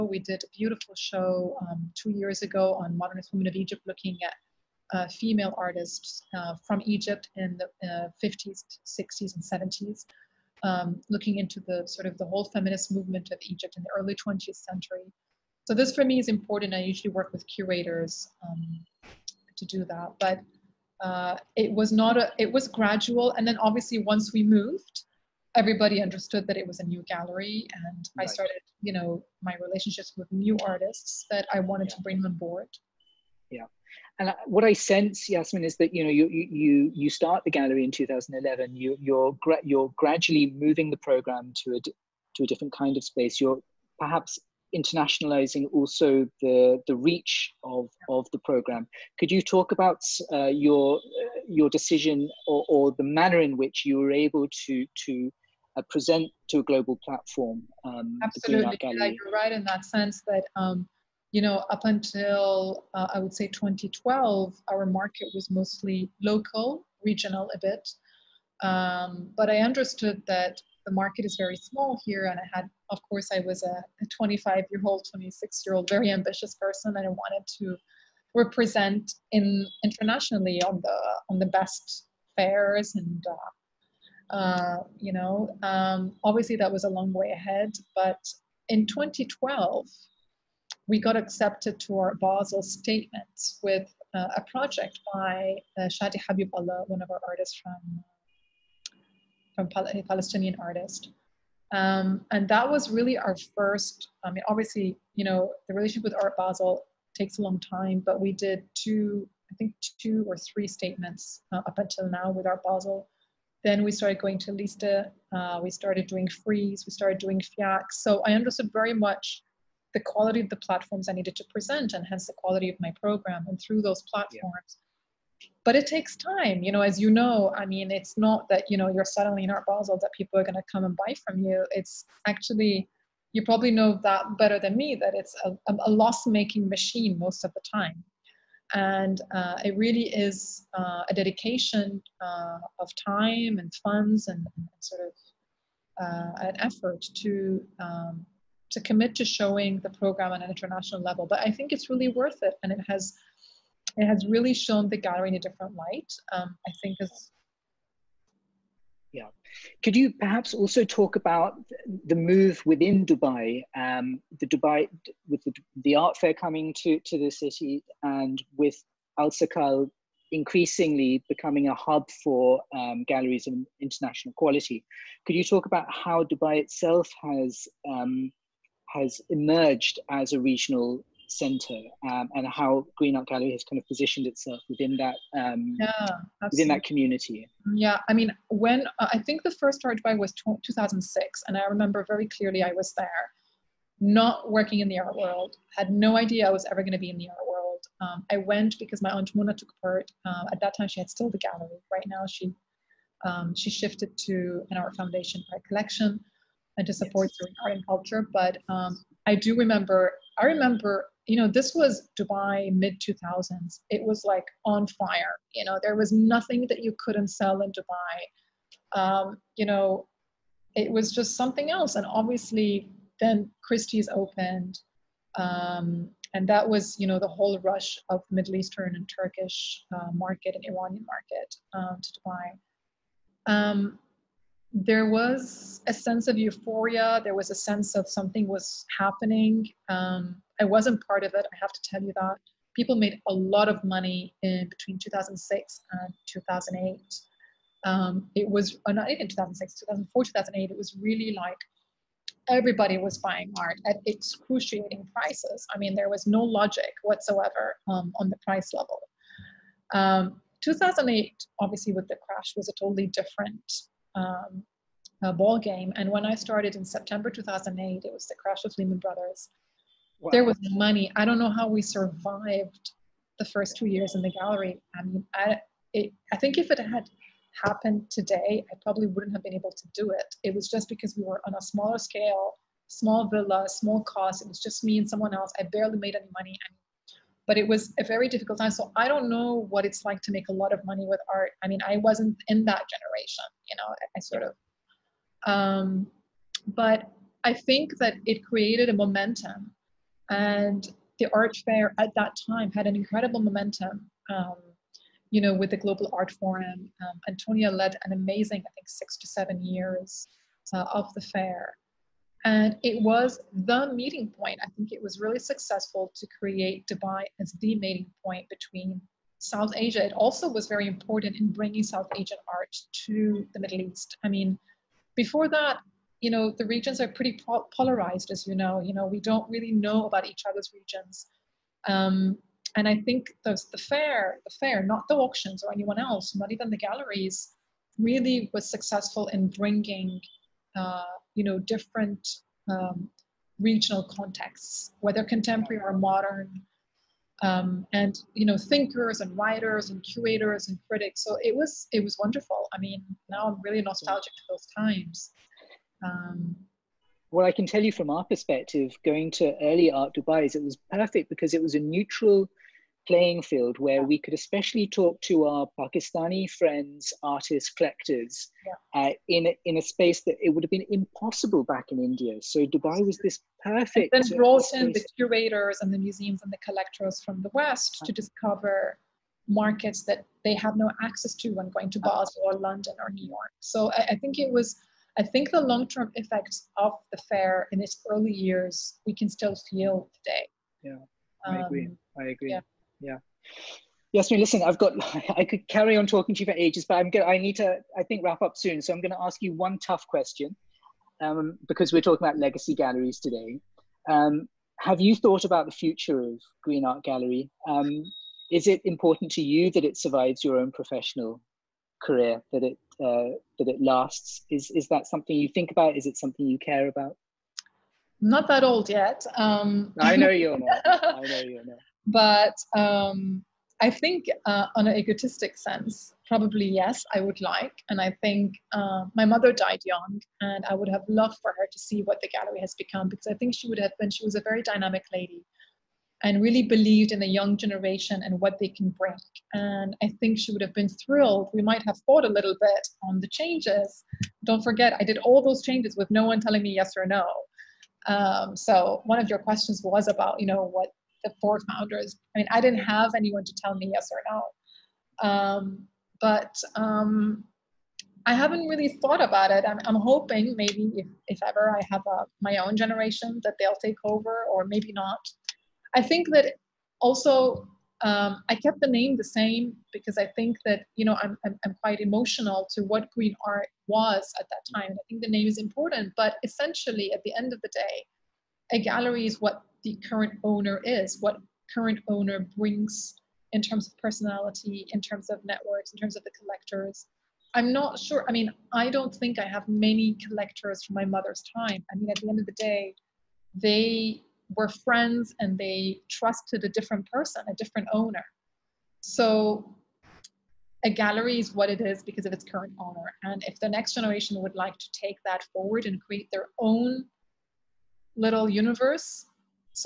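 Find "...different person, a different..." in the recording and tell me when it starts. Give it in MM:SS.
08:16.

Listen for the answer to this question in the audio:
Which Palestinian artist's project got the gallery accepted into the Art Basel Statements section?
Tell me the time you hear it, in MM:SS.
01:35.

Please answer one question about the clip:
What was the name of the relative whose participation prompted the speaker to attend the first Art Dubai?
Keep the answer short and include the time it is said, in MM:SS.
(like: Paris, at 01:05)
Mona, at 03:19.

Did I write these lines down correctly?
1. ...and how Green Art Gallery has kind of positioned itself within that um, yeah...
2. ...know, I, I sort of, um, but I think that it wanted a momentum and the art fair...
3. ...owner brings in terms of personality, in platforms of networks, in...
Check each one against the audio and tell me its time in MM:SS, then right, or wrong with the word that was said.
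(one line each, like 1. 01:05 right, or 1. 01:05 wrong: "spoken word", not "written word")
1. 03:02 right
2. 04:53 wrong: "created", not "wanted"
3. 08:02 wrong: "terms", not "platforms".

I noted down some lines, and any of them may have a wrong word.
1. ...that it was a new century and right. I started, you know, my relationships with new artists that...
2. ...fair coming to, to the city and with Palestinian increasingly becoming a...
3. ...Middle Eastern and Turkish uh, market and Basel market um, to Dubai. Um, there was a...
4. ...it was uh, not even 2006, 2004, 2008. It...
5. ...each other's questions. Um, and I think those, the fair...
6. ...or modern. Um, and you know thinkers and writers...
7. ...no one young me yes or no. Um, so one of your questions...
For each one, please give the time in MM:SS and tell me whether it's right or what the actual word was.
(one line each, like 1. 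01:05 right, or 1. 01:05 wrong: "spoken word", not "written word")
1. 00:26 wrong: "gallery", not "century"
2. 02:46 wrong: "Alserkal", not "Palestinian"
3. 03:48 wrong: "Iranian", not "Basel"
4. 04:08 right
5. 05:30 wrong: "regions", not "questions"
6. 05:45 right
7. 07:26 wrong: "telling", not "young".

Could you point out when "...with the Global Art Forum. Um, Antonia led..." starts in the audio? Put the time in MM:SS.
05:05.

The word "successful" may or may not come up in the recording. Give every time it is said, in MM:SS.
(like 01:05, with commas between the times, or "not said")
05:15, 05:38.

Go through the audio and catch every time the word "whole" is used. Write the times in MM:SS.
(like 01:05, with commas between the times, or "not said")
00:12, 03:47.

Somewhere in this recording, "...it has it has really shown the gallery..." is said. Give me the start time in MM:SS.
02:32.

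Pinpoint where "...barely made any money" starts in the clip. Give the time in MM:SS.
04:45.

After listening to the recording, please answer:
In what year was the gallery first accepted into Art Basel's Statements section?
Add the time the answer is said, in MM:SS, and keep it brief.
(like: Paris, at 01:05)
2012, at 01:28.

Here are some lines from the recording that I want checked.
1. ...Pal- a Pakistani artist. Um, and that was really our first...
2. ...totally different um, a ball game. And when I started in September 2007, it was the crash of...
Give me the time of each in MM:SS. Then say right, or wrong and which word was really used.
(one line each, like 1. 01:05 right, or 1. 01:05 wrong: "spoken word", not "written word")
1. 01:39 wrong: "Palestinian", not "Pakistani"
2. 04:22 wrong: "2008", not "2007".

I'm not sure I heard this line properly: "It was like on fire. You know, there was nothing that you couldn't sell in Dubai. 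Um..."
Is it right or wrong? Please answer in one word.
right.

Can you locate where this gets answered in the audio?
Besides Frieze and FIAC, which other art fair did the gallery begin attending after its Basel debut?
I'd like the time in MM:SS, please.
01:54.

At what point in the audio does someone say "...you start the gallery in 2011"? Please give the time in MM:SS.
00:36.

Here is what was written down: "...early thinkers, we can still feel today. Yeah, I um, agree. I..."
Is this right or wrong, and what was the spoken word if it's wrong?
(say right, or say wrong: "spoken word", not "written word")
wrong: "years", not "thinkers".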